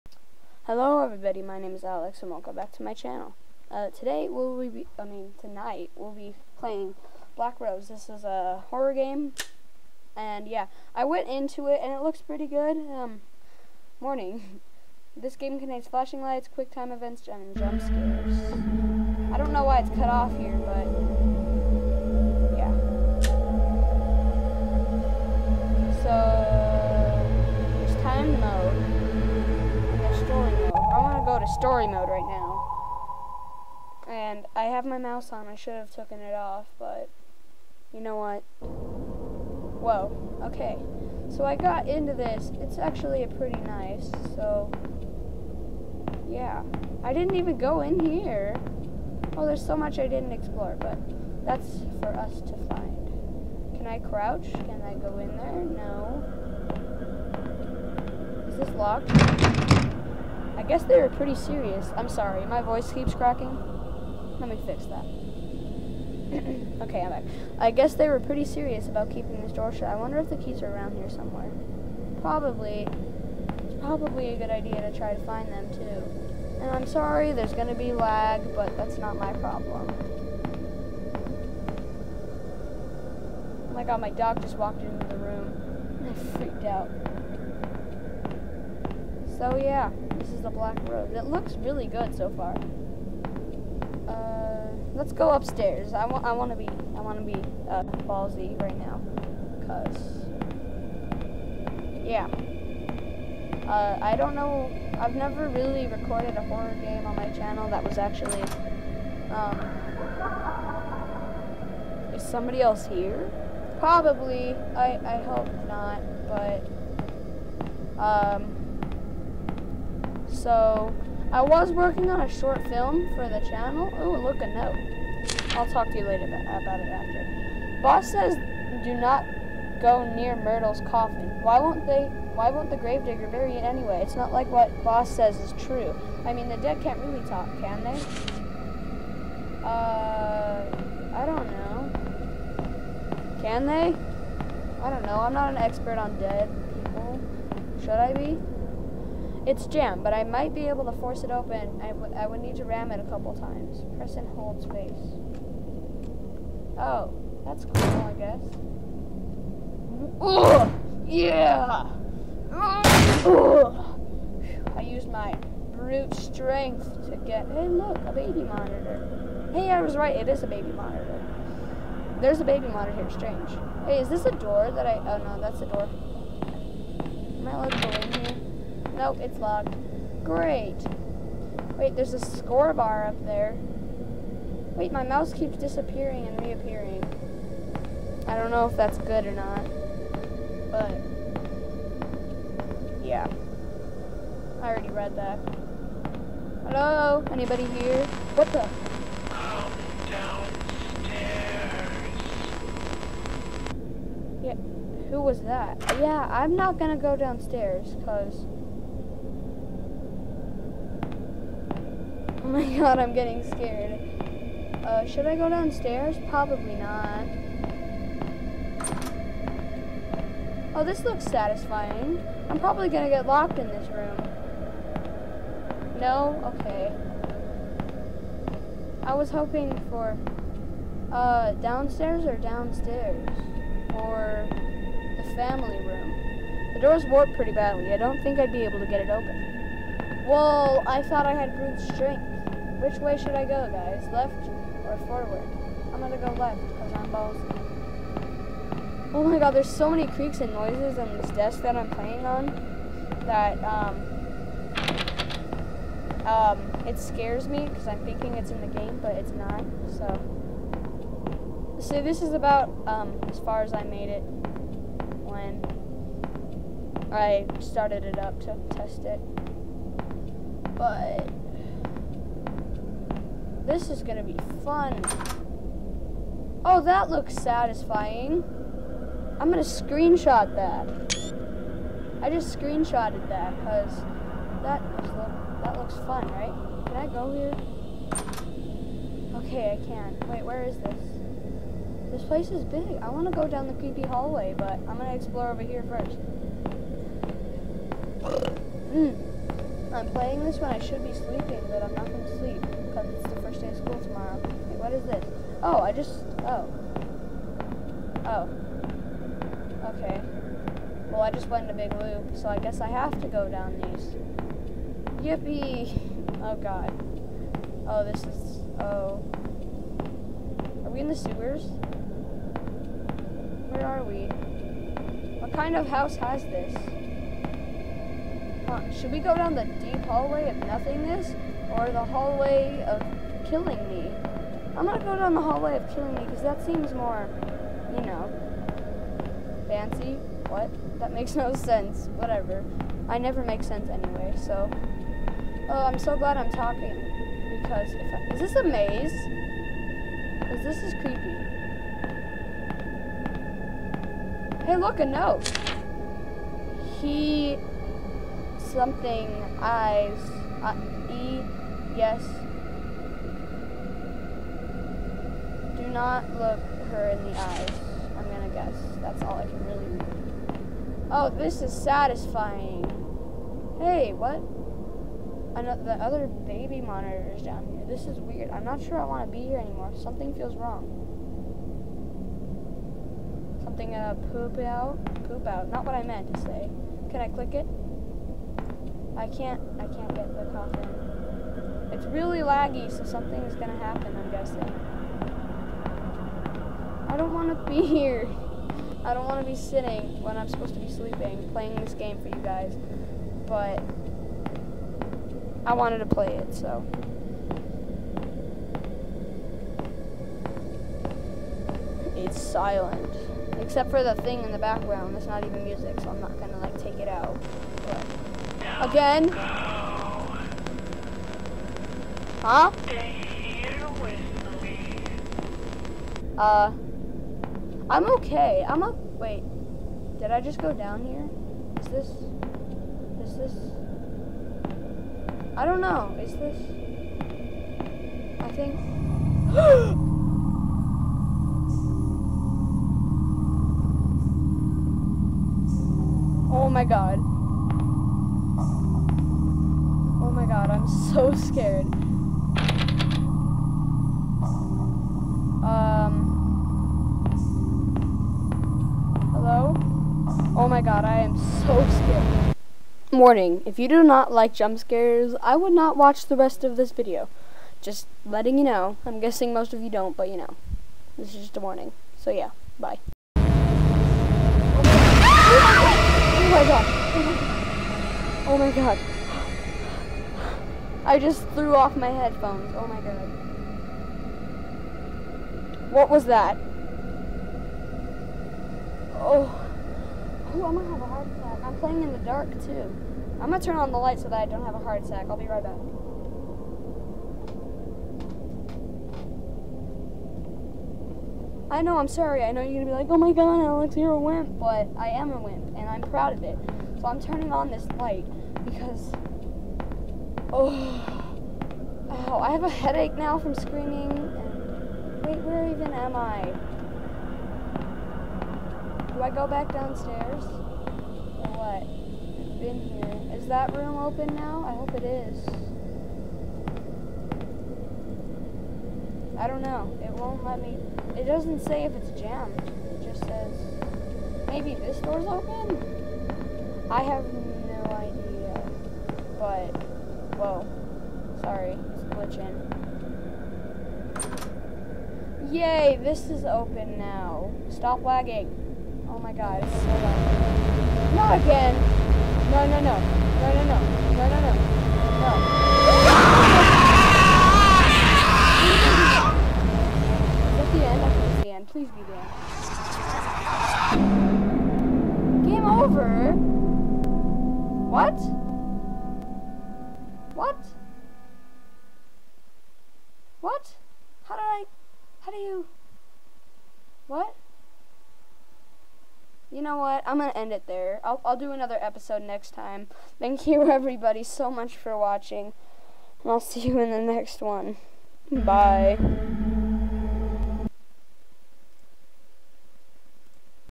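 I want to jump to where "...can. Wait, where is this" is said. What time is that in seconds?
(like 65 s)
289 s.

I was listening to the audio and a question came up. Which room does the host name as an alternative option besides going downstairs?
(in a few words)
the family room.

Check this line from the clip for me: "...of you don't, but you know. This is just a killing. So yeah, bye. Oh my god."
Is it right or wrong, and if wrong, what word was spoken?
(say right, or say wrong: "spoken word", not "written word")
wrong: "warning", not "killing".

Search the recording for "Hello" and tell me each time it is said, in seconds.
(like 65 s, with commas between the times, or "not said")
0 s, 196 s, 459 s.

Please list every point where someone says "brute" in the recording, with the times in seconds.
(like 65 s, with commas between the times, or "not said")
165 s, 241 s.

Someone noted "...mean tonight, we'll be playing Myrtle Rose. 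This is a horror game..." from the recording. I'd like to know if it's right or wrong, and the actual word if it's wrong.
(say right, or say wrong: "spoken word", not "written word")
wrong: "Black", not "Myrtle".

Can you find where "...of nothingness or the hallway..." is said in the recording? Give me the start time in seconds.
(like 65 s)
330 s.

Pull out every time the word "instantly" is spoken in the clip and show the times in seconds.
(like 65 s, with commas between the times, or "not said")
not said.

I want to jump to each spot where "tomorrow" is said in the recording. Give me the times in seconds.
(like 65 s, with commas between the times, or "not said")
303 s.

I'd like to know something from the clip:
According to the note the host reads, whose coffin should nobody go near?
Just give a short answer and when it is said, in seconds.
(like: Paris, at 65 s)
Myrtle's, at 130 s.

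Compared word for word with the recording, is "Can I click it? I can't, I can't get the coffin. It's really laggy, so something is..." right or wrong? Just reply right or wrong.
right.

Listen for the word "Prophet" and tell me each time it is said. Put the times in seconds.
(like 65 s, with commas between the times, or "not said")
not said.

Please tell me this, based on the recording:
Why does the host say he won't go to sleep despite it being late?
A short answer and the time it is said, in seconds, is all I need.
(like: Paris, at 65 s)
first day of school, at 303 s.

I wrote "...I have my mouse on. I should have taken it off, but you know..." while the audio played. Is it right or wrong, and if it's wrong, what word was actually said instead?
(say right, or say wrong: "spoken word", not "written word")
right.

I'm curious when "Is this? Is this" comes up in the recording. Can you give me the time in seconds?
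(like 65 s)
431 s.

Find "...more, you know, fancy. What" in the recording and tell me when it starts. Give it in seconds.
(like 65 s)
336 s.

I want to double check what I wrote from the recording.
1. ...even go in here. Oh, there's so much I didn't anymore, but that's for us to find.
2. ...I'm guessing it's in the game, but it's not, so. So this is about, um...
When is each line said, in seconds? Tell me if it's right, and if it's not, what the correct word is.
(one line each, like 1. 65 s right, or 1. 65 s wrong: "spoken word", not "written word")
1. 47 s wrong: "explore", not "anymore"
2. 257 s wrong: "thinking", not "guessing".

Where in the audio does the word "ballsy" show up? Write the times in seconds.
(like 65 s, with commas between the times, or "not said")
98 s, 247 s.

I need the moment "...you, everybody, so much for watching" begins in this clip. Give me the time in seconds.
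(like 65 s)
583 s.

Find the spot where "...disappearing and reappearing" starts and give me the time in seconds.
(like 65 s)
185 s.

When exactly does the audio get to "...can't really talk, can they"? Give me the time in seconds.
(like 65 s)
136 s.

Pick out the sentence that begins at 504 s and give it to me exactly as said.
But I am a wimp, and I'm proud of it.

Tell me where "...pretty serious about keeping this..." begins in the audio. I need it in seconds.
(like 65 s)
68 s.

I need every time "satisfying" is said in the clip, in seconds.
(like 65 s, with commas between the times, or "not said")
221 s, 277 s, 371 s.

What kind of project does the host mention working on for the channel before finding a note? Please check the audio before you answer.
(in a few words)
a short film.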